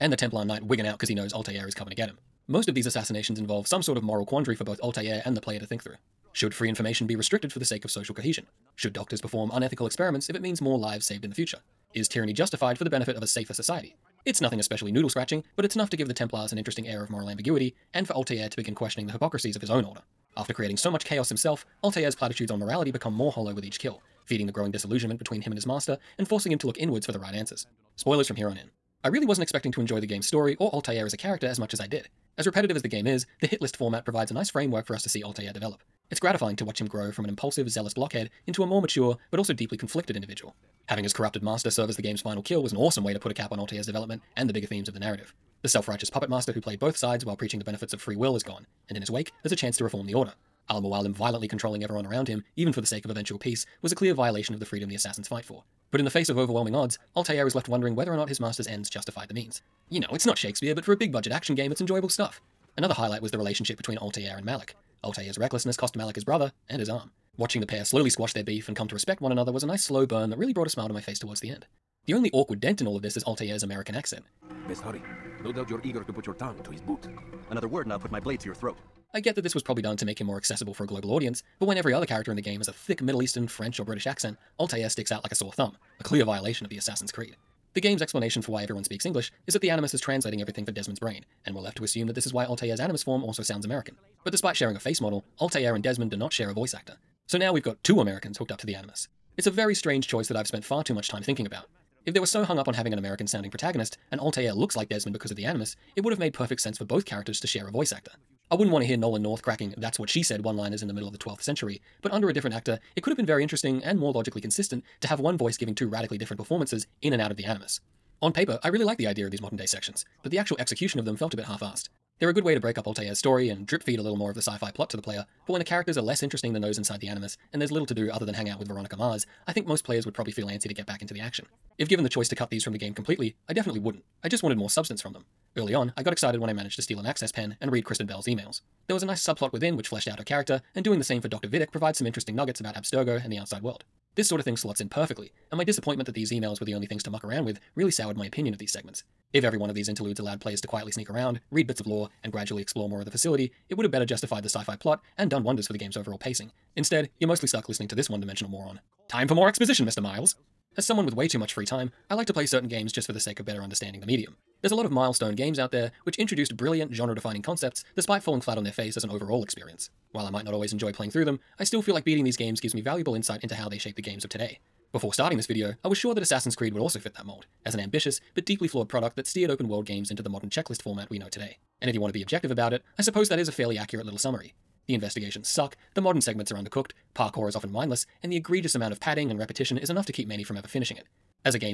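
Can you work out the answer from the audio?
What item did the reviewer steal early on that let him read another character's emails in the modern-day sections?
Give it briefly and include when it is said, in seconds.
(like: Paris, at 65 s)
An access pen, at 137 s.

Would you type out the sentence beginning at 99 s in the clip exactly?
It's a very strange choice that I've spent far too much time thinking about.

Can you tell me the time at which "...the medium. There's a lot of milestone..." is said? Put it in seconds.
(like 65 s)
164 s.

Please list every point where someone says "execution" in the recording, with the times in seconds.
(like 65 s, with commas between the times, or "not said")
120 s.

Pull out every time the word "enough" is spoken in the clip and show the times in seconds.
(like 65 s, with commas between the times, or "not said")
15 s, 189 s.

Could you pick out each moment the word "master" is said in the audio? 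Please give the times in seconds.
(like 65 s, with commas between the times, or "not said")
25 s, 41 s, 46 s, 58 s.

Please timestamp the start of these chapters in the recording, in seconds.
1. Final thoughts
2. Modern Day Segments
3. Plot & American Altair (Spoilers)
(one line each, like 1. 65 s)
1. 160 s
2. 117 s
3. 27 s.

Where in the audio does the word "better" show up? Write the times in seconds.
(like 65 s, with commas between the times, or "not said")
153 s, 163 s.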